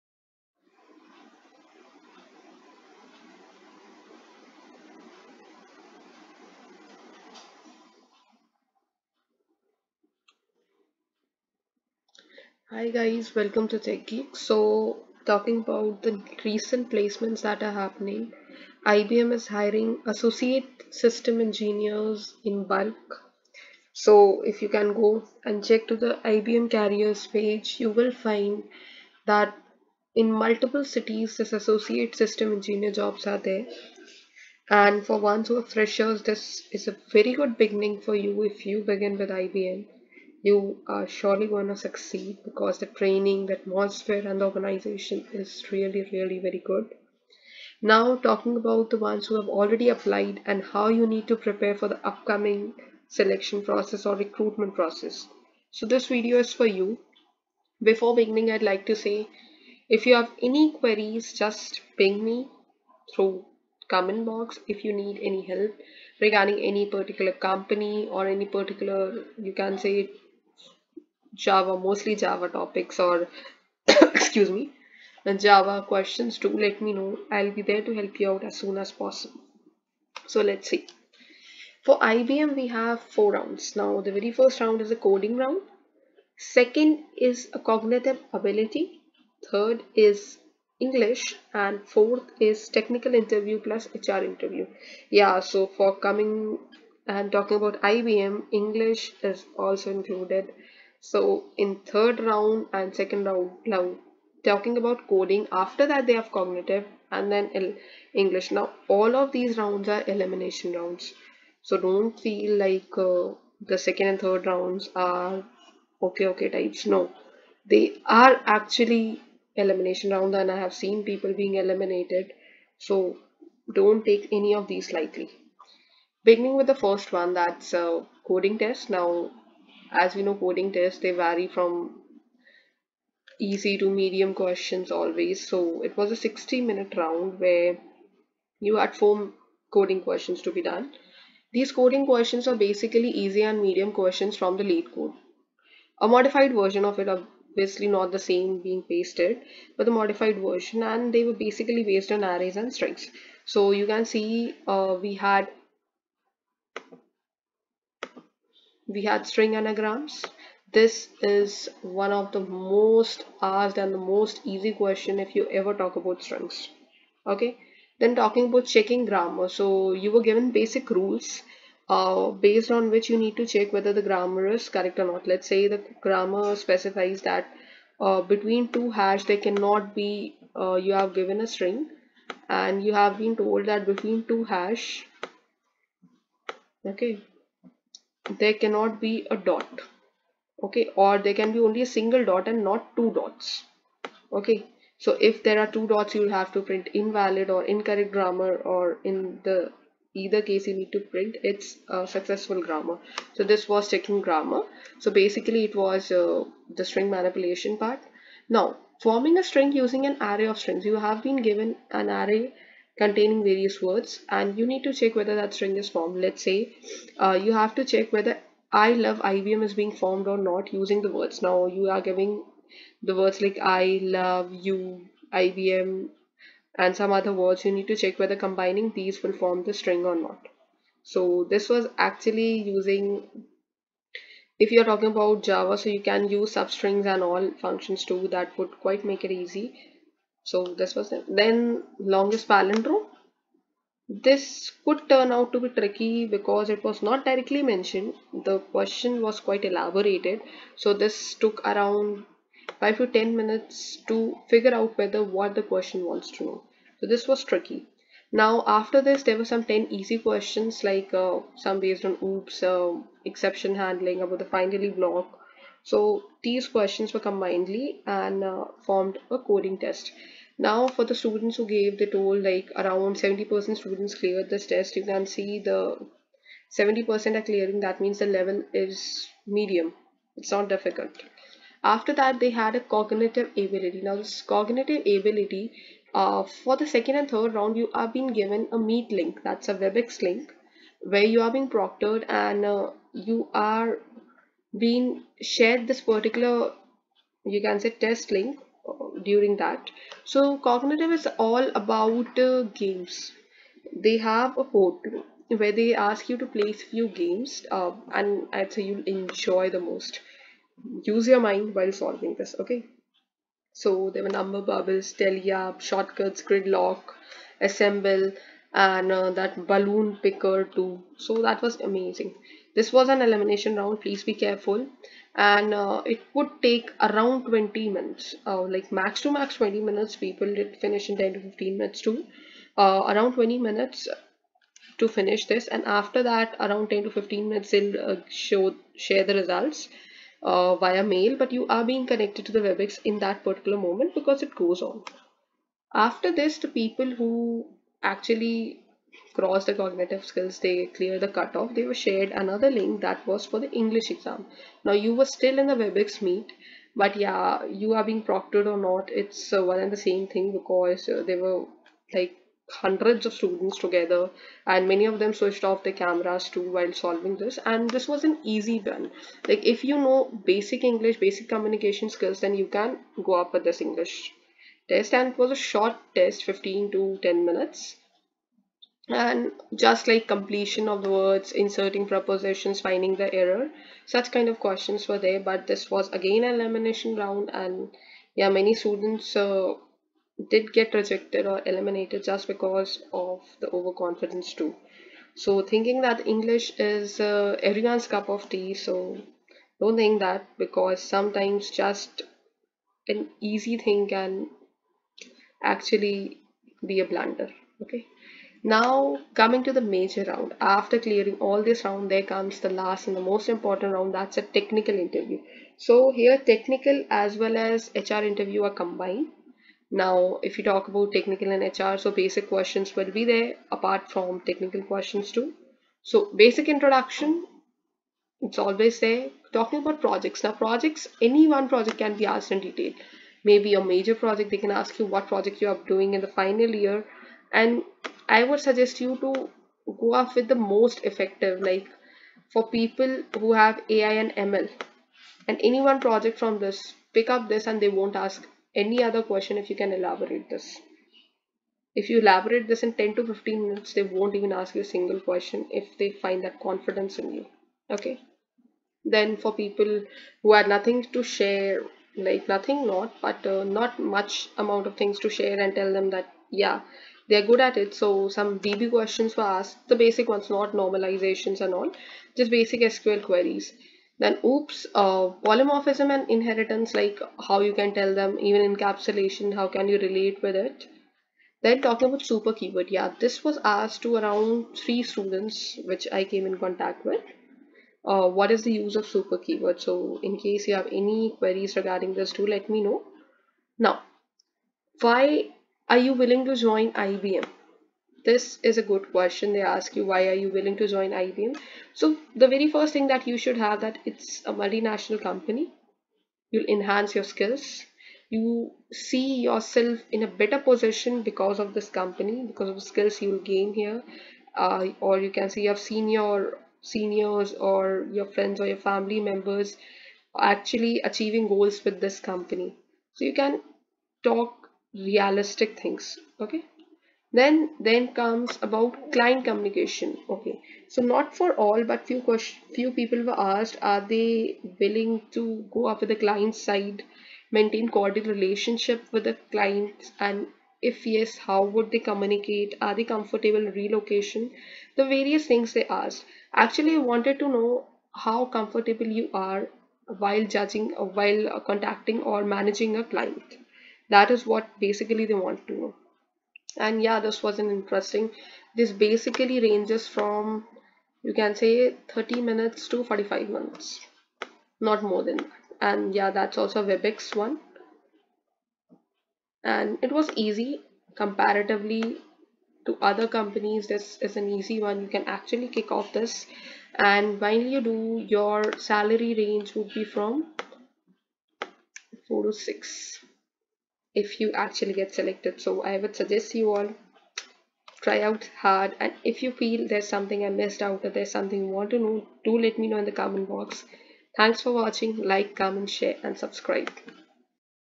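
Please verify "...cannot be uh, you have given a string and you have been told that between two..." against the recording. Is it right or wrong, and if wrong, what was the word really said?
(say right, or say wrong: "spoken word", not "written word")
right.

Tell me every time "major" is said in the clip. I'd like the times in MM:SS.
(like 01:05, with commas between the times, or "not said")
06:49, 07:13.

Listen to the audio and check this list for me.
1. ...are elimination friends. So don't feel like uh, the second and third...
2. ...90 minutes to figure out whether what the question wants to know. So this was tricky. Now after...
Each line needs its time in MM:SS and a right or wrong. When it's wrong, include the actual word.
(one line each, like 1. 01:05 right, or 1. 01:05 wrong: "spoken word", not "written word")
1. 01:49 wrong: "rounds", not "friends"
2. 04:13 wrong: "10", not "90".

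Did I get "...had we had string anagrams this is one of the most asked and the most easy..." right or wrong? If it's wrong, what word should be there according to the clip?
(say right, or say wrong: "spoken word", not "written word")
right.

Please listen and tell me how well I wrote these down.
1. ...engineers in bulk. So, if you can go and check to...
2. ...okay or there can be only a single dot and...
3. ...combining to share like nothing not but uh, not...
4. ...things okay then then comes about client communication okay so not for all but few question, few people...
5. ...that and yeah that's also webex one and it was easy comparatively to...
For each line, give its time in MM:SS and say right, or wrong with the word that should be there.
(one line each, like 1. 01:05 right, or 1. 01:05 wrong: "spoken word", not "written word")
1. 00:21 right
2. 03:10 right
3. 07:40 wrong: "nothing", not "combining"
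4. 08:45 right
5. 09:25 right.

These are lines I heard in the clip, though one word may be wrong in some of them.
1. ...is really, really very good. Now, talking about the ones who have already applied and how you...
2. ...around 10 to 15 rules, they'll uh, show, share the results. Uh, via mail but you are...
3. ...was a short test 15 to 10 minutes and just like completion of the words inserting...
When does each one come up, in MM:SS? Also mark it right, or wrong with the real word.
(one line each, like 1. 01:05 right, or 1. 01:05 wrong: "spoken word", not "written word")
1. 00:45 right
2. 05:36 wrong: "minutes", not "rules"
3. 06:15 right.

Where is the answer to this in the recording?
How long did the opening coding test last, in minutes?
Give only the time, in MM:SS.
02:16.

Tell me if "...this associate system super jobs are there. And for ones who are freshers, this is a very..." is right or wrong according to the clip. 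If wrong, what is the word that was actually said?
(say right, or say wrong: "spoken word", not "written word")
wrong: "engineer", not "super".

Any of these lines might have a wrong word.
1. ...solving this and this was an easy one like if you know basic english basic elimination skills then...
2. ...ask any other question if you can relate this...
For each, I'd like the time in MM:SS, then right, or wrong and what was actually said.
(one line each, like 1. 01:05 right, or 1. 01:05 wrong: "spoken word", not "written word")
1. 06:06 wrong: "communication", not "elimination"
2. 07:28 wrong: "elaborate", not "relate".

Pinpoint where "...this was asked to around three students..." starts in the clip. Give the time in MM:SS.
08:03.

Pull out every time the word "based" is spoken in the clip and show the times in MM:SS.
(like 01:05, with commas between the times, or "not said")
02:31, 02:52, 04:21.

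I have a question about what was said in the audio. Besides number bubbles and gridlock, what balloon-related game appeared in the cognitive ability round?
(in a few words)
Balloon picker.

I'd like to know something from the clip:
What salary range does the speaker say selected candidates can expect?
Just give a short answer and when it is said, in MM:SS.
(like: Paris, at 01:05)
4 to 6, at 09:42.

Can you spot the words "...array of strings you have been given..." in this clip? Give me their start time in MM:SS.
03:30.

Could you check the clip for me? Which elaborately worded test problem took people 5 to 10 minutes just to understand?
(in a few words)
Longest palindrome.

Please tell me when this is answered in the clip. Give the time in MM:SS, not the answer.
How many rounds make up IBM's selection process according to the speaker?
01:23.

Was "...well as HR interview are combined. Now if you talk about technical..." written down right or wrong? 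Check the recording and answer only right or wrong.
right.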